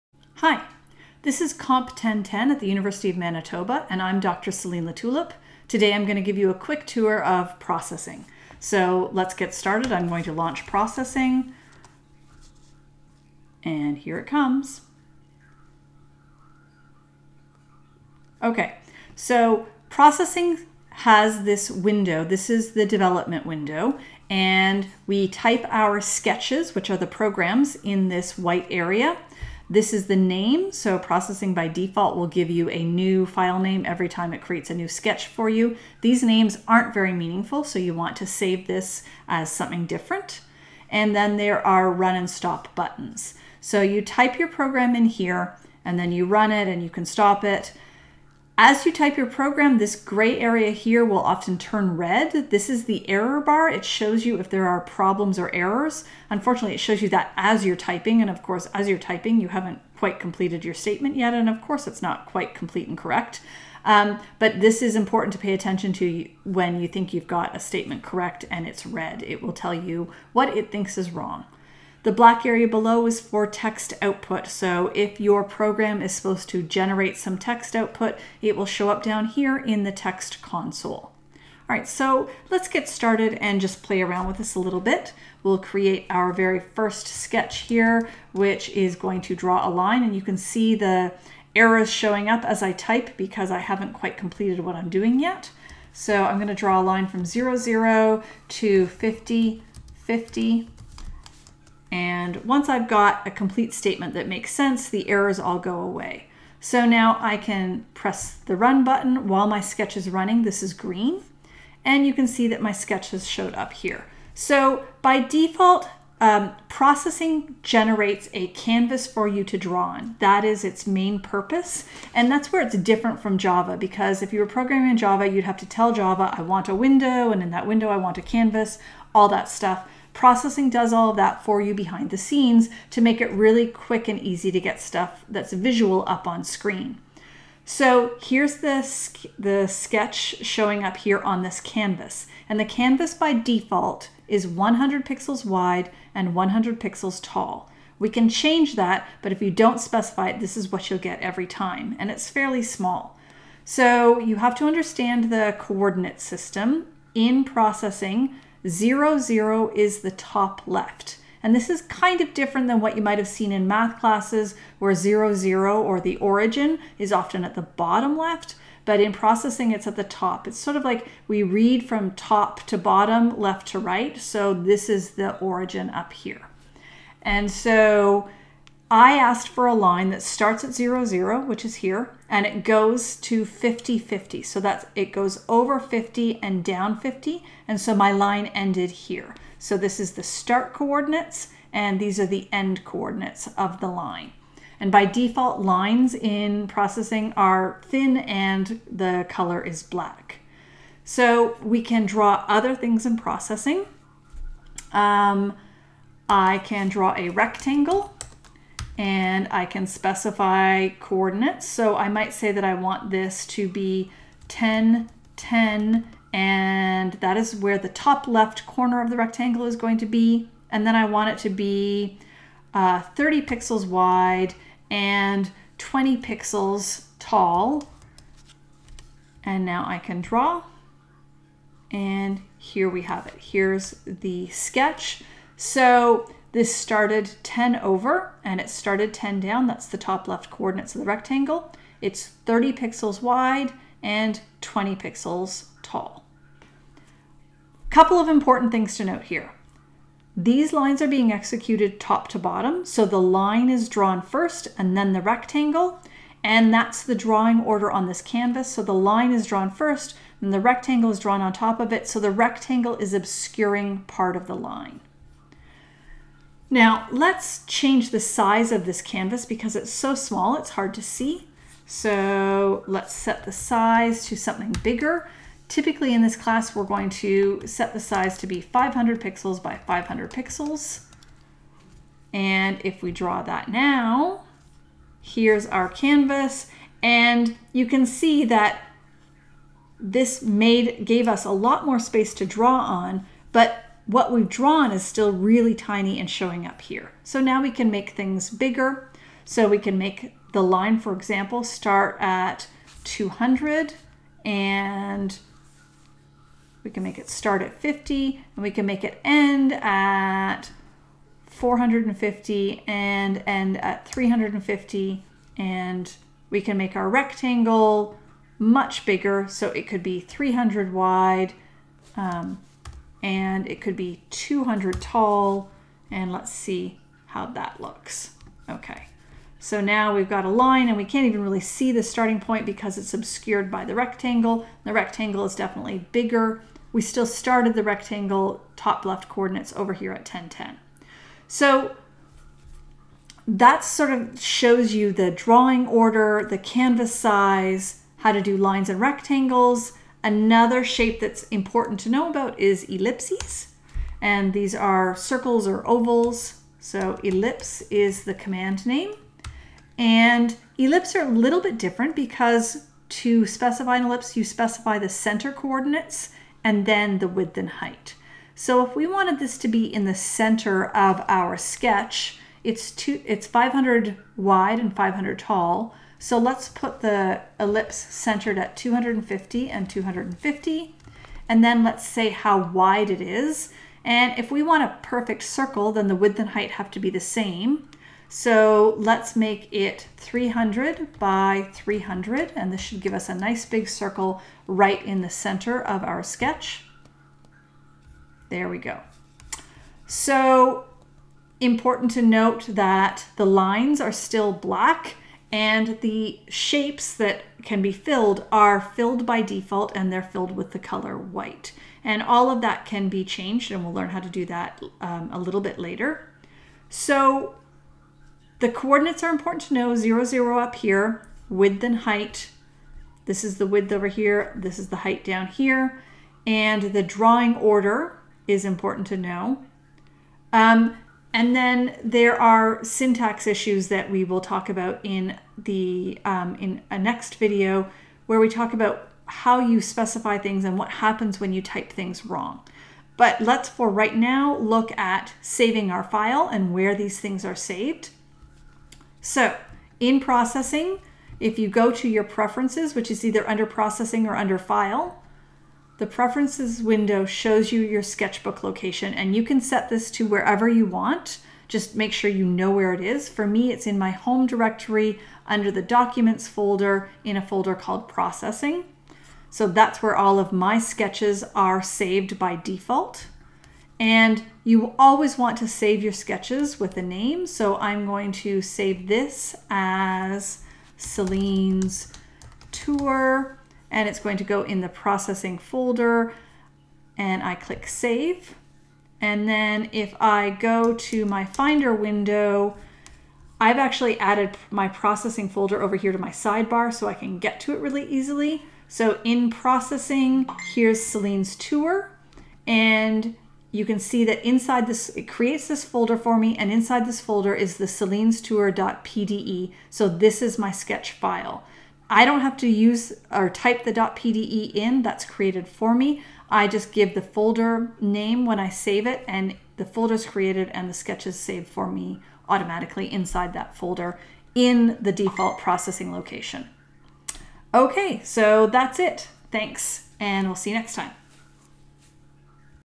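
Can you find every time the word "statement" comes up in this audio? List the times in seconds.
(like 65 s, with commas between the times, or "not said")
60 s, 67 s, 103 s.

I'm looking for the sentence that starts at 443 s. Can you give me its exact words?
But let's for right now look at saving our file and where these things are saved.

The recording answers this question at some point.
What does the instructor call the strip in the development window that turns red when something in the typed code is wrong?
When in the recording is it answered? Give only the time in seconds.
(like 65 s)
53 s.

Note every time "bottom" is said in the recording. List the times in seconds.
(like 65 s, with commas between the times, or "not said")
167 s, 172 s, 252 s.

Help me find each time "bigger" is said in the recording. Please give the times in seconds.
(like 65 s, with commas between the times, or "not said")
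274 s, 298 s, 319 s, 336 s.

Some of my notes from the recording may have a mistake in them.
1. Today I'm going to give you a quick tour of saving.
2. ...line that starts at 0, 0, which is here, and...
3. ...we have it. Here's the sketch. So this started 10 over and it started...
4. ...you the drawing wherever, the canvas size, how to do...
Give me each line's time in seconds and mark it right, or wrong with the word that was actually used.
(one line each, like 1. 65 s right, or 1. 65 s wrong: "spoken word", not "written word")
1. 5 s wrong: "processing", not "saving"
2. 179 s right
3. 232 s right
4. 344 s wrong: "order", not "wherever".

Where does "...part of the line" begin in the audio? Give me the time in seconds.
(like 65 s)
263 s.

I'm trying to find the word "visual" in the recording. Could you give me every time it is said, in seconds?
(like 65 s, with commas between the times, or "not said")
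135 s.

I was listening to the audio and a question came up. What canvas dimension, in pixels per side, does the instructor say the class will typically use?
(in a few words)
500.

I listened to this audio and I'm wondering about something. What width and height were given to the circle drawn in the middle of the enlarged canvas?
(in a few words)
300 by 300.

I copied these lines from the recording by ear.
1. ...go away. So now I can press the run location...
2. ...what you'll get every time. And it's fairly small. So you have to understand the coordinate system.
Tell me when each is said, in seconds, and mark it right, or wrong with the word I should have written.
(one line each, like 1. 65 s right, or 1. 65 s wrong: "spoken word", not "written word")
1. 105 s wrong: "button", not "location"
2. 150 s right.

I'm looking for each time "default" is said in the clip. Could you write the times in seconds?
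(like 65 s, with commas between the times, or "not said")
31 s, 115 s, 143 s, 195 s, 409 s, 472 s, 525 s.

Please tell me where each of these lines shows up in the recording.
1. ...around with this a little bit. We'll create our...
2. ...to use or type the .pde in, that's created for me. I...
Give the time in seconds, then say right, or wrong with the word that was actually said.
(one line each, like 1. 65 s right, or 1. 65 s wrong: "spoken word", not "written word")
1. 84 s right
2. 512 s right.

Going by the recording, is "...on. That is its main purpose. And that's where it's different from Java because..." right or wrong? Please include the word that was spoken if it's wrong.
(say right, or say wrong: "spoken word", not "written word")
right.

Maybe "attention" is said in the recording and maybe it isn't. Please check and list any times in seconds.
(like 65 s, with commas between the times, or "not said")
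65 s.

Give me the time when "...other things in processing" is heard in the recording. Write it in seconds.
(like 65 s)
202 s.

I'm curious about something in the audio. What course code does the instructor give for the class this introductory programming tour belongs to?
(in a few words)
Comp 1010.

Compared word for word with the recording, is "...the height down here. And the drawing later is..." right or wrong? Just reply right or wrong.
wrong.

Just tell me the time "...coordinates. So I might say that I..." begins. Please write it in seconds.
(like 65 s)
210 s.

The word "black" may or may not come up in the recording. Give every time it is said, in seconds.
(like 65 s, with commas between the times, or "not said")
72 s, 199 s, 404 s.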